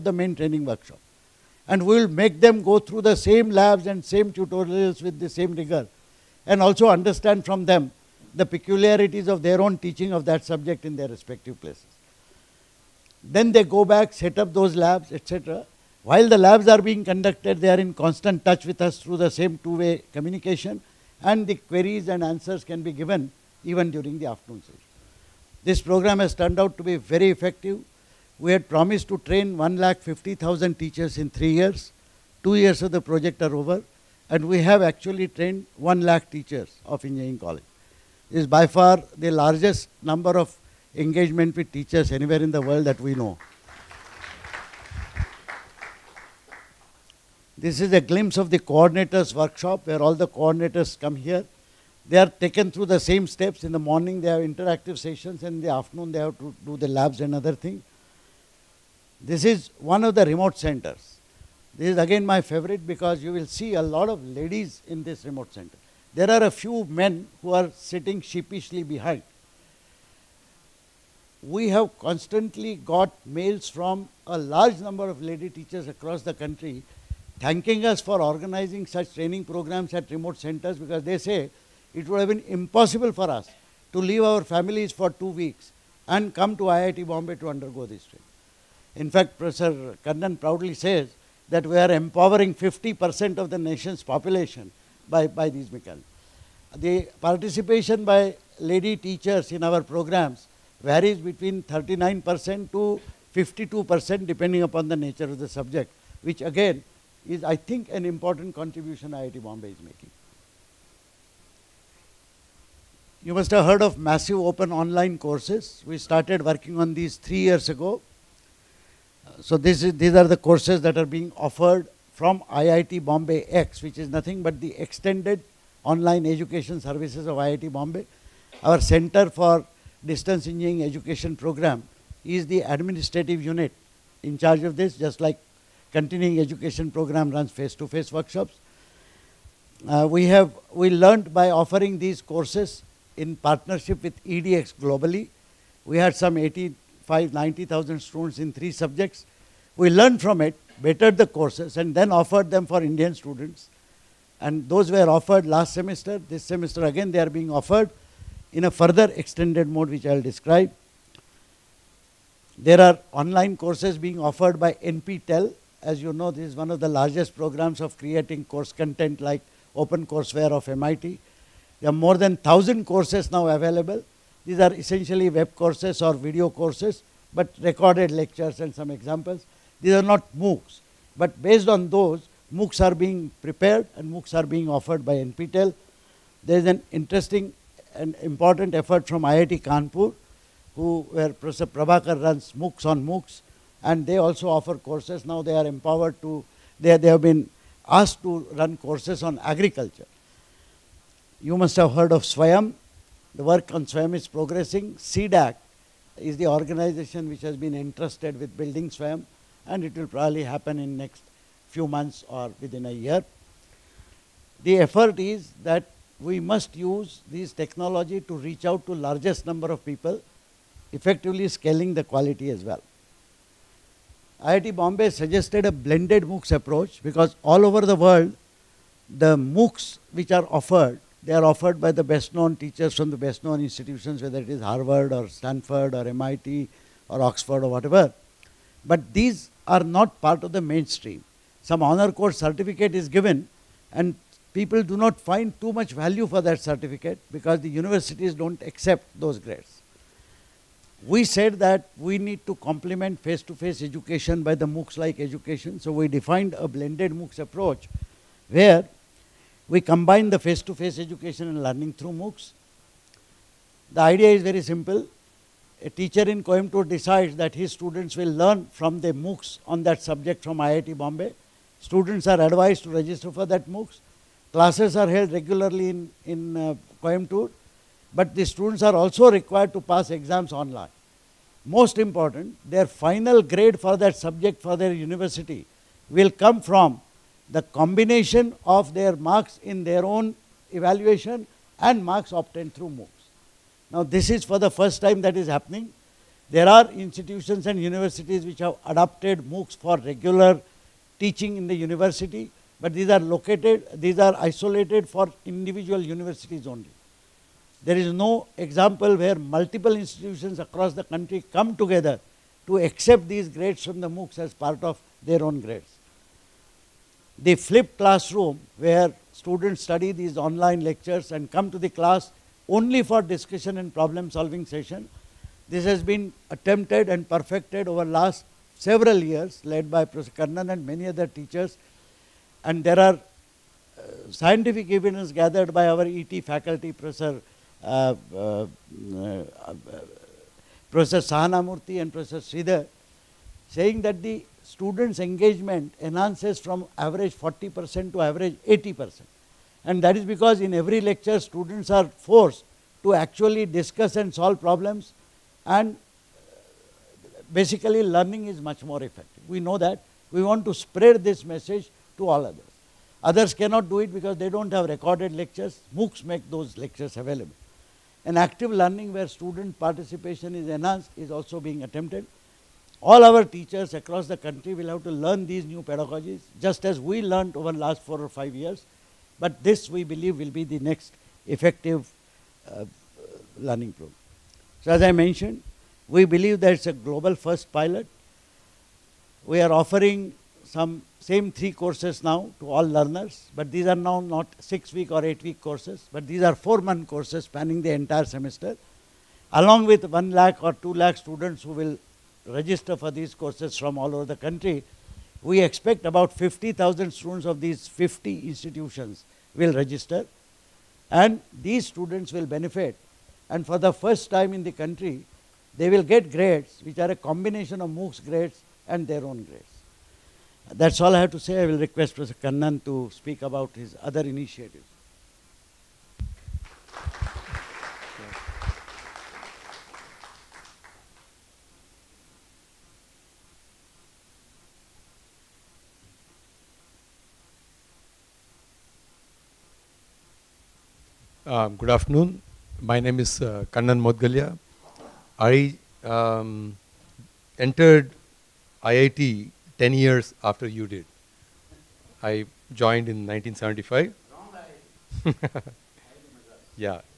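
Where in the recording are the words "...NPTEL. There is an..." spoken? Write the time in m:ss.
3:05.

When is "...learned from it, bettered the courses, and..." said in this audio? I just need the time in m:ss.
2:29.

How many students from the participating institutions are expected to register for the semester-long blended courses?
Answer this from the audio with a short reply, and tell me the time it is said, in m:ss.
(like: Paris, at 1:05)
50,000, at 6:46.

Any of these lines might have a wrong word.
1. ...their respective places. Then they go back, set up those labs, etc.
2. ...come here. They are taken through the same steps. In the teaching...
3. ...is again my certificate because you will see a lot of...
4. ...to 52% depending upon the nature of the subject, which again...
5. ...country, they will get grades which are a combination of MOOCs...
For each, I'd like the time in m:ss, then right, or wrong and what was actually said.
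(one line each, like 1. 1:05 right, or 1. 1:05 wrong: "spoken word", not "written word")
1. 0:10 right
2. 0:50 wrong: "morning", not "teaching"
3. 1:01 wrong: "favorite", not "certificate"
4. 1:42 right
5. 6:54 right.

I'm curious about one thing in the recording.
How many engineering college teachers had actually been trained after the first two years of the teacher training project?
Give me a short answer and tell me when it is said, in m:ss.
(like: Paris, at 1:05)
1 lakh, at 0:35.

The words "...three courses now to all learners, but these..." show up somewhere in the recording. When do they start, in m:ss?
6:31.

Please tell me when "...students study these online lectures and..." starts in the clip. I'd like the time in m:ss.
5:19.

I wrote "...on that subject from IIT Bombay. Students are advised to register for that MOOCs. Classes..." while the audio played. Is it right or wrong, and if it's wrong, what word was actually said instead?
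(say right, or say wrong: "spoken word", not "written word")
right.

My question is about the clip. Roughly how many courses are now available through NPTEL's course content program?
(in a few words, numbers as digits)
More than 1,000.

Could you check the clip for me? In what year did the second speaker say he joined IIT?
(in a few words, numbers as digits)
1975.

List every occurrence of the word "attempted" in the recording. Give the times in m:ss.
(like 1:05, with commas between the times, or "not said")
5:26, 6:11.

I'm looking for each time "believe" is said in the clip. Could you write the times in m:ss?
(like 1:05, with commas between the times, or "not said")
6:20, 6:26.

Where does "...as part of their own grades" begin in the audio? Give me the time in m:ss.
5:14.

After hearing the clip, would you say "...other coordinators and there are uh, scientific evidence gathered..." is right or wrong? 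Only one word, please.
wrong.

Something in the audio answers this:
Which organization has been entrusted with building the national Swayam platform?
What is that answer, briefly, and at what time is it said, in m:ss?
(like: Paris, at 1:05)
CDAC, at 3:24.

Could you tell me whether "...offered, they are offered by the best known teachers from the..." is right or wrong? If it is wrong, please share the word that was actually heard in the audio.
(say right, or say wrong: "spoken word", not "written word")
right.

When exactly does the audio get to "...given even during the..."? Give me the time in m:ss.
0:22.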